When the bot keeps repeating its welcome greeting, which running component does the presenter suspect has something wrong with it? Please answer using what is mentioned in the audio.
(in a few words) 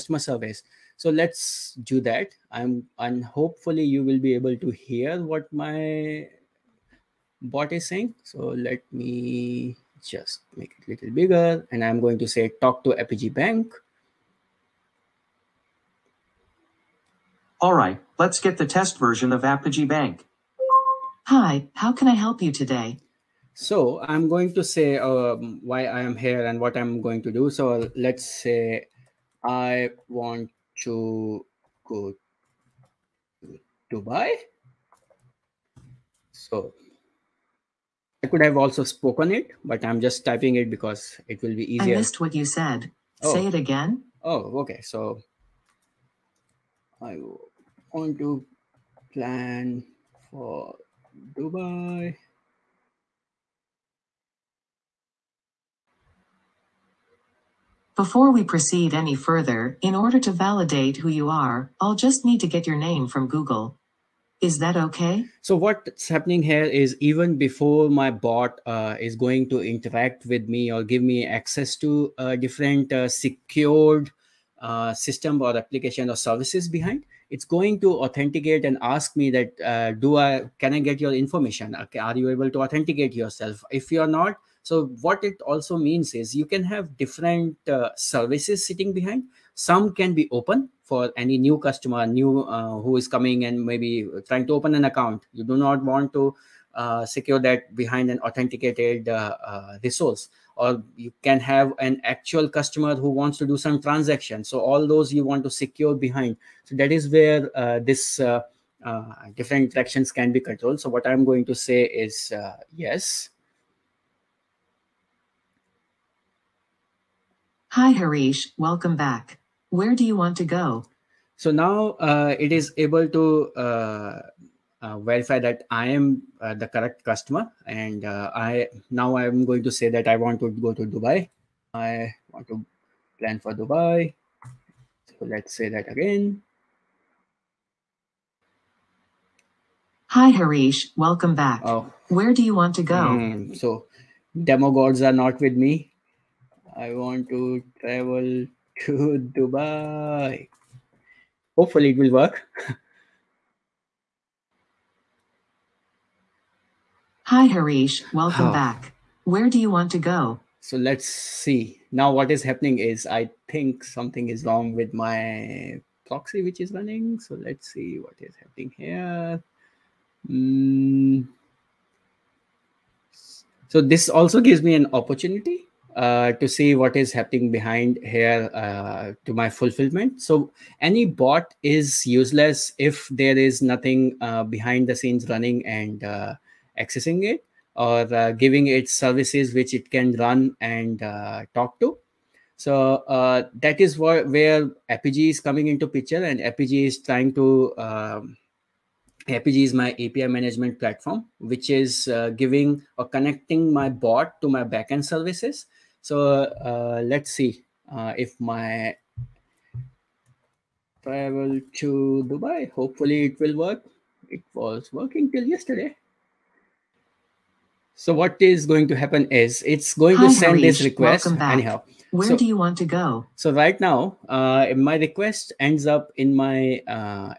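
Proxy.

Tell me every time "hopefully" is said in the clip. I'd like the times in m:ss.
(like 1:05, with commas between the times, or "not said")
0:03, 2:31, 3:32.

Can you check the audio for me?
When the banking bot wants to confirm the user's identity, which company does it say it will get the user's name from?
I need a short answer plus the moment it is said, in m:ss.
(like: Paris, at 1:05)
Google, at 1:03.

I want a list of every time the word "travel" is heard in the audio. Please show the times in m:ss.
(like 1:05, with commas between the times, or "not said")
2:27, 3:31.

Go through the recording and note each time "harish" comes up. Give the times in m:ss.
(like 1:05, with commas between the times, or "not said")
1:57, 2:20, 2:37, 3:40.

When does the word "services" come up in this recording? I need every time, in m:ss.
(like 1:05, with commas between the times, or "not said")
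0:00, 1:16, 1:27, 3:08, 3:25.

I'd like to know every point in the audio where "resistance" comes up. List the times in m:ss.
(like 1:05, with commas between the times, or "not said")
not said.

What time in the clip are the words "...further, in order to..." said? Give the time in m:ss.
0:59.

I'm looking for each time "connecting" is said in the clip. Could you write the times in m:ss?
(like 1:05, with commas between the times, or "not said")
3:23.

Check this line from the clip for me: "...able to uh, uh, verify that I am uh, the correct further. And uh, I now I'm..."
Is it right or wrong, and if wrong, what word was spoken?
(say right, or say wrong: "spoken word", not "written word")
wrong: "customer", not "further".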